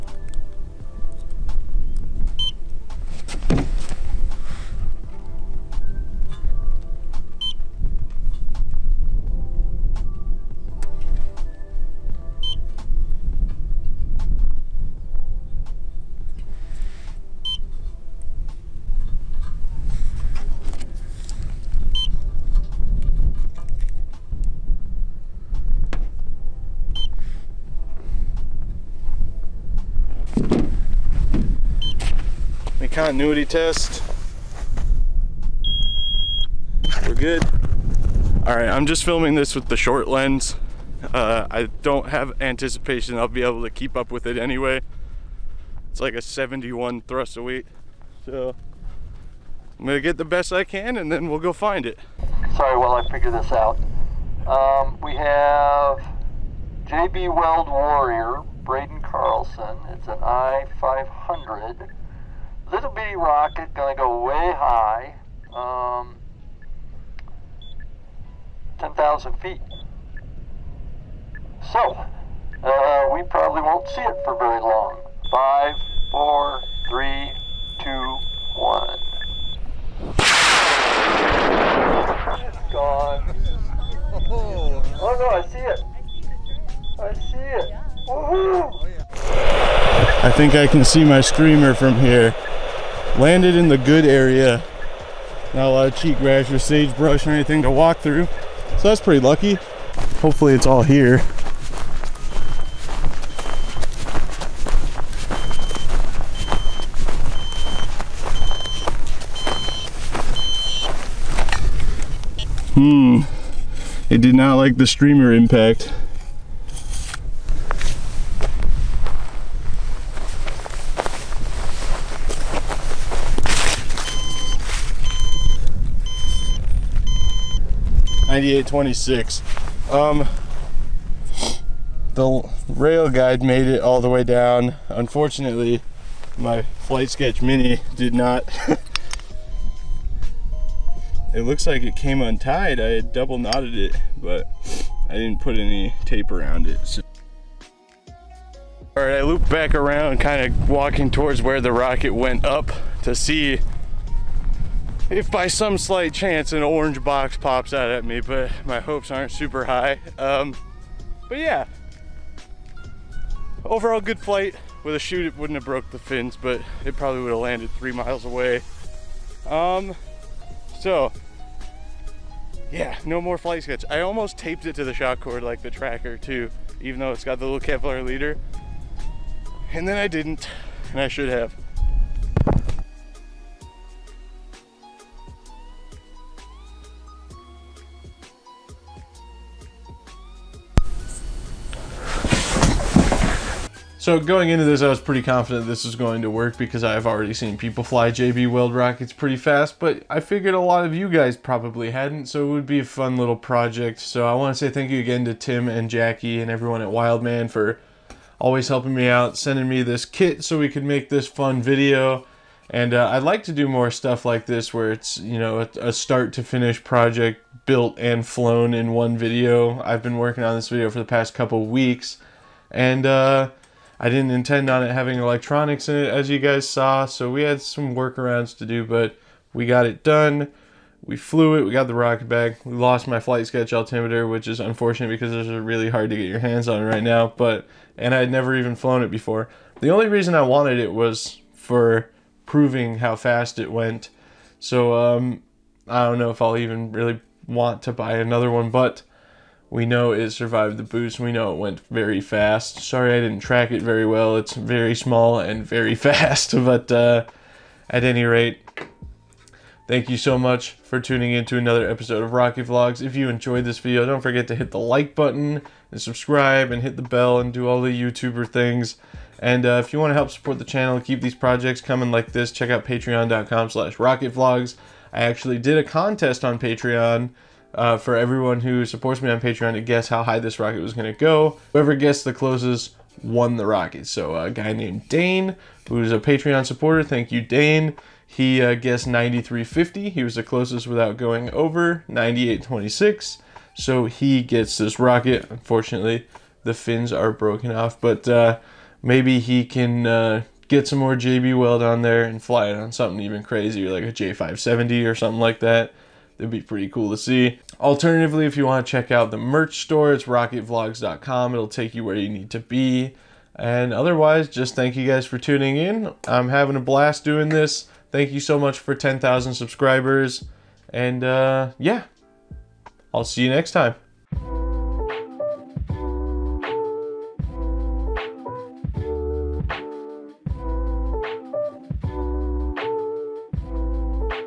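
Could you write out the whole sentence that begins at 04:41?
Whoever guessed the closest won the rocket.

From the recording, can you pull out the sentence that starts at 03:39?
I've been working on this video for the past couple weeks.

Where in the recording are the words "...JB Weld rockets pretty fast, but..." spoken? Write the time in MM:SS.
03:18.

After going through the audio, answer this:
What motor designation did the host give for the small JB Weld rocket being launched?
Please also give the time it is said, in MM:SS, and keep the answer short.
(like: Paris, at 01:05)
I-500, at 01:00.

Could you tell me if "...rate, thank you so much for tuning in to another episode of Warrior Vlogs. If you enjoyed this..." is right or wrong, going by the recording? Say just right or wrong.
wrong.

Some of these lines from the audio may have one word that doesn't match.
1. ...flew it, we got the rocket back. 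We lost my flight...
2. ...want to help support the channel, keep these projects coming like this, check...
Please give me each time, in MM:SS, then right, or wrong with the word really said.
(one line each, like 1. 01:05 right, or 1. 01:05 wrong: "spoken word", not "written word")
1. 03:51 right
2. 04:29 right.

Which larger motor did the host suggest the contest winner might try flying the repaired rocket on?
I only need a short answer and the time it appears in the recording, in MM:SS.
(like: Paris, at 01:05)
J570, at 05:04.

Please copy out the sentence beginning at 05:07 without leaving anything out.
Alternatively, if you want to check out the merch store, it's rocketvlogs.com.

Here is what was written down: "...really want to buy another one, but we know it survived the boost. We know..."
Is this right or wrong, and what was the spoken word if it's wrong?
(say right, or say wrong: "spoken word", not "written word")
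right.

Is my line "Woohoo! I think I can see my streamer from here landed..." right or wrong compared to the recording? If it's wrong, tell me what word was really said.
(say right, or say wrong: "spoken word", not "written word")
right.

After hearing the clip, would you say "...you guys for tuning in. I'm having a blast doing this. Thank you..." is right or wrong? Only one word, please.
right.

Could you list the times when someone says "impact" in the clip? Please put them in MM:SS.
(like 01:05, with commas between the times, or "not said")
01:55.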